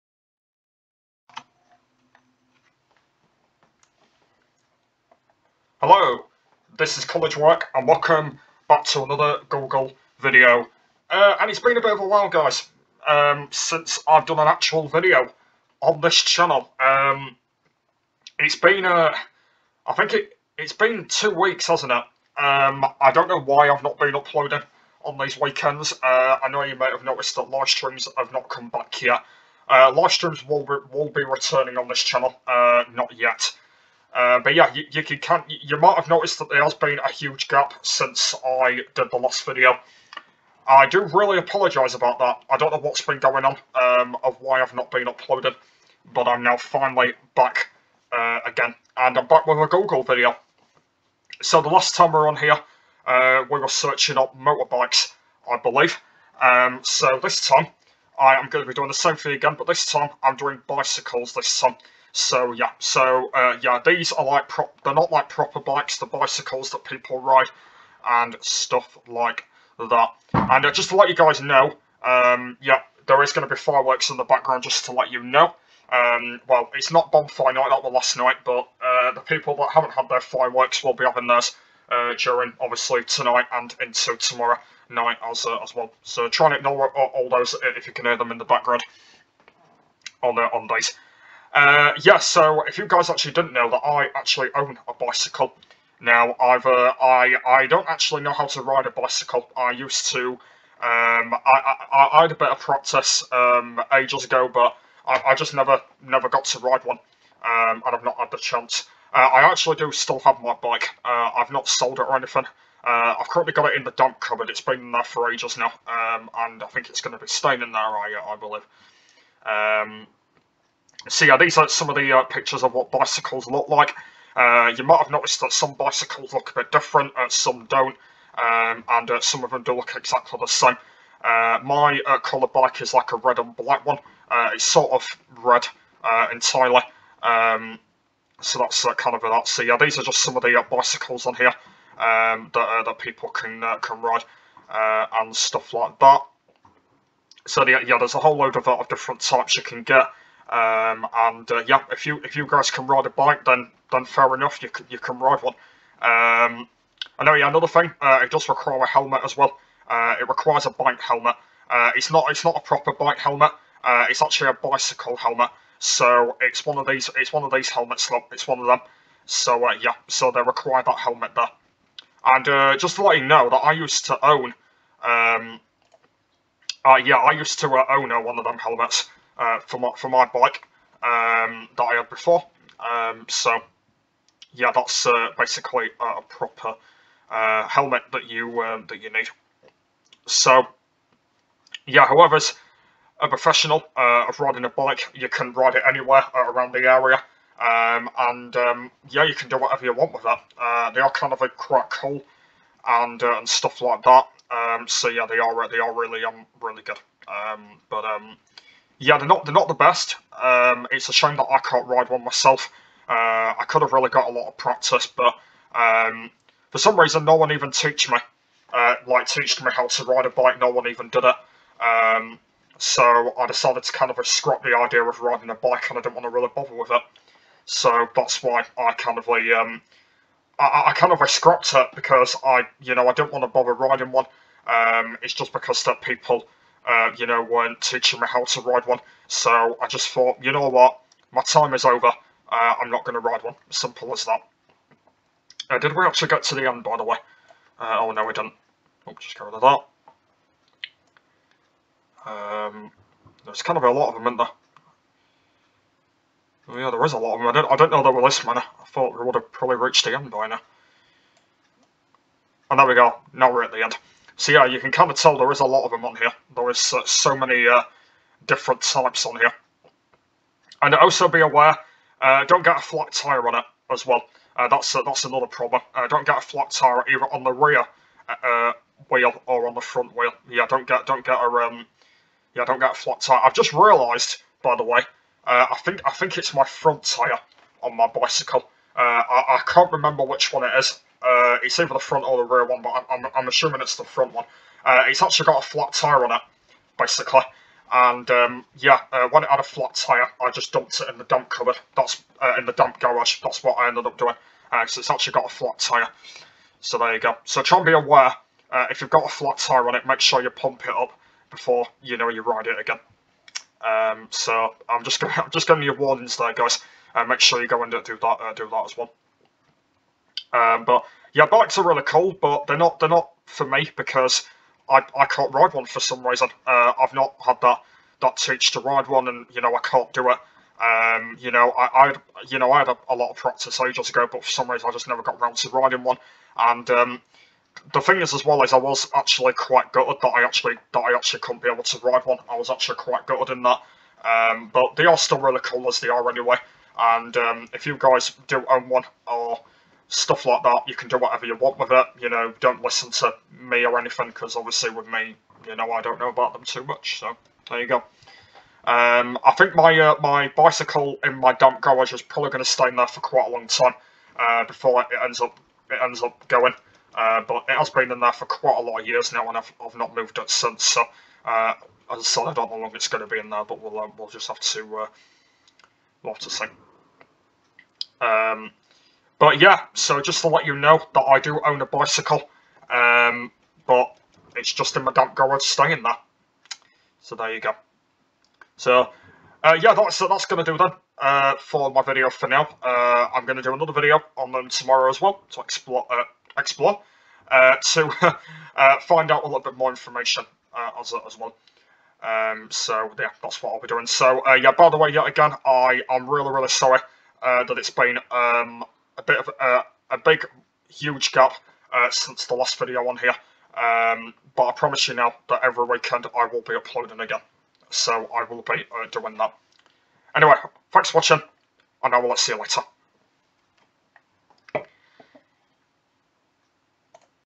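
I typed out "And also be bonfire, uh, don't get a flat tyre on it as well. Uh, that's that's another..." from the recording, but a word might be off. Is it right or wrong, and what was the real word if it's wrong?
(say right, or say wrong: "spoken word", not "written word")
wrong: "aware", not "bonfire".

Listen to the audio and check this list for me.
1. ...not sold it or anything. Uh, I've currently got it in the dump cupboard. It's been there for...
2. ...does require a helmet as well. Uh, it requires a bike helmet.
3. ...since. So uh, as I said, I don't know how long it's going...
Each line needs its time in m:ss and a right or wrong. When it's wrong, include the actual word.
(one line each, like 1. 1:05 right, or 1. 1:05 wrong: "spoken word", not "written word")
1. 1:51 right
2. 2:38 right
3. 6:10 right.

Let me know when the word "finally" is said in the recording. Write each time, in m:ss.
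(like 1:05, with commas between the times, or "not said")
0:46.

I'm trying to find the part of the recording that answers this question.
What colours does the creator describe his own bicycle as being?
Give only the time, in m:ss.
2:13.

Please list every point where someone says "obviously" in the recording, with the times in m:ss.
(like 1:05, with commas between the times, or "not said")
1:22, 5:54.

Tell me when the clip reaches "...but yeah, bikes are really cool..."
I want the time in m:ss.
5:20.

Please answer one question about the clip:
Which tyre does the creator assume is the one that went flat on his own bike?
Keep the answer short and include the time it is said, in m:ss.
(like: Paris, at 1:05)
The front one, at 4:54.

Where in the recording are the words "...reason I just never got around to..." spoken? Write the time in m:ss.
5:34.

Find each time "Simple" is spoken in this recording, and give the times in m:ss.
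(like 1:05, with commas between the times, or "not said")
4:03.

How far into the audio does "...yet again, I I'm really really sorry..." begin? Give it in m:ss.
6:45.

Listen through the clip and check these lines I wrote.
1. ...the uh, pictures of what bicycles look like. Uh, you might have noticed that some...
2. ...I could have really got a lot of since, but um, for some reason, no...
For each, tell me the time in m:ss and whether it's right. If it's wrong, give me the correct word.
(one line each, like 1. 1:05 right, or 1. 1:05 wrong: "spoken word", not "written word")
1. 2:01 right
2. 3:33 wrong: "practice", not "since".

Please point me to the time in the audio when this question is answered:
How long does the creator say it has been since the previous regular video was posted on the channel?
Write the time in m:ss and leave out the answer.
0:21.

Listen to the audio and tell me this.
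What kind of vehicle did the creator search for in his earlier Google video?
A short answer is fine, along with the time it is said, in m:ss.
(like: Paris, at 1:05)
Motorbikes, at 0:54.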